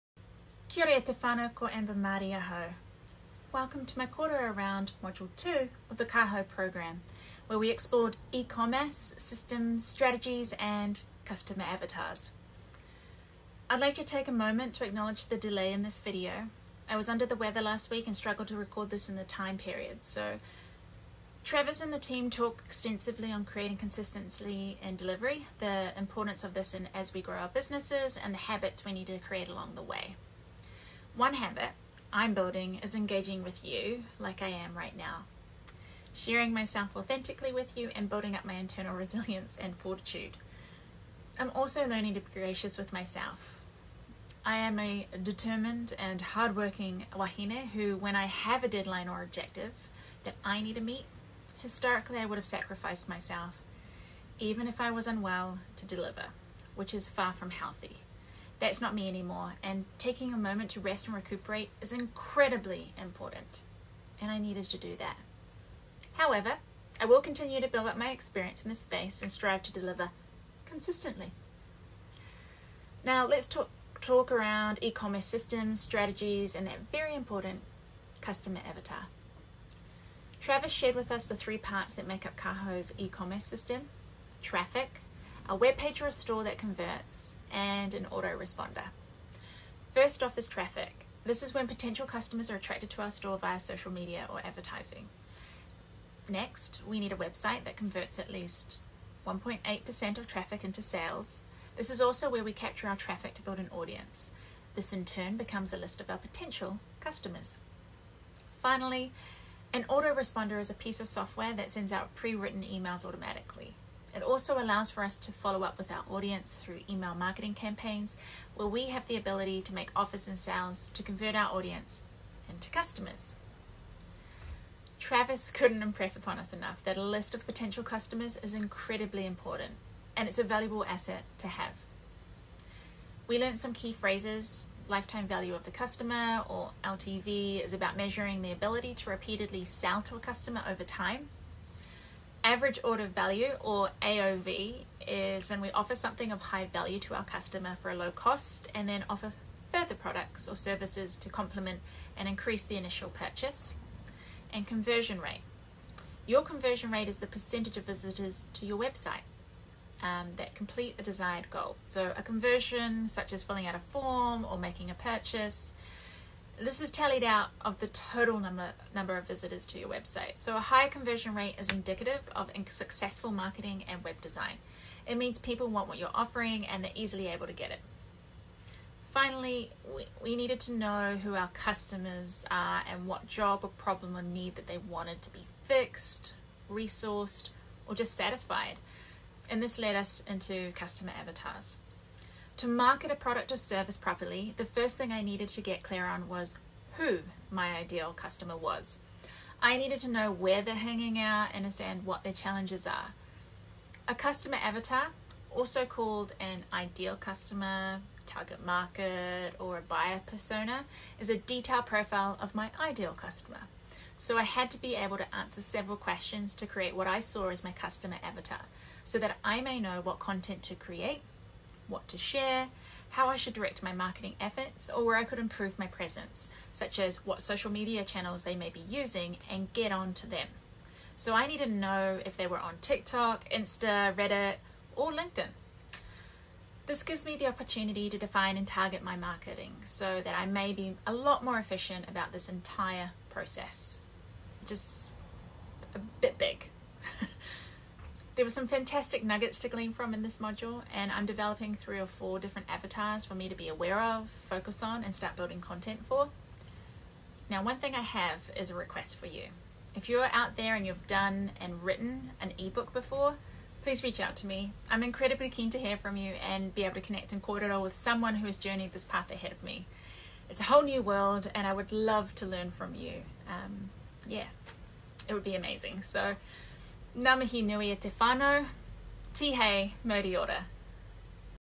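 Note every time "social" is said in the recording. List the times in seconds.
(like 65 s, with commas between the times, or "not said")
93 s, 227 s.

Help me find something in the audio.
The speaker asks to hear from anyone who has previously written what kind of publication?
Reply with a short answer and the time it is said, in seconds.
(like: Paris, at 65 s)
ebook, at 262 s.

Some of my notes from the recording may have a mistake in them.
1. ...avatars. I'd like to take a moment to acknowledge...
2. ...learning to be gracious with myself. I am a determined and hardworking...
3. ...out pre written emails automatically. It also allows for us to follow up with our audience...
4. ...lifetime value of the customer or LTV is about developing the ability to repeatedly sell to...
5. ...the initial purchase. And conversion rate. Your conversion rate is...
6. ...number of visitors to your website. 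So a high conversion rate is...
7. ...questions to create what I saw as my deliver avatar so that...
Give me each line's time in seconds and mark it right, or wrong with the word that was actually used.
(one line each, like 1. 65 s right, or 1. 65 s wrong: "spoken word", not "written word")
1. 11 s right
2. 41 s right
3. 111 s right
4. 134 s wrong: "measuring", not "developing"
5. 152 s right
6. 168 s right
7. 215 s wrong: "customer", not "deliver".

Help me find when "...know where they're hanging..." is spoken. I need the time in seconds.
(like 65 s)
200 s.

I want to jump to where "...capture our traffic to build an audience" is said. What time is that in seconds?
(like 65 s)
102 s.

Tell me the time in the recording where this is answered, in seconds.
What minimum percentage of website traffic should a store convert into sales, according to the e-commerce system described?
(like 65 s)
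99 s.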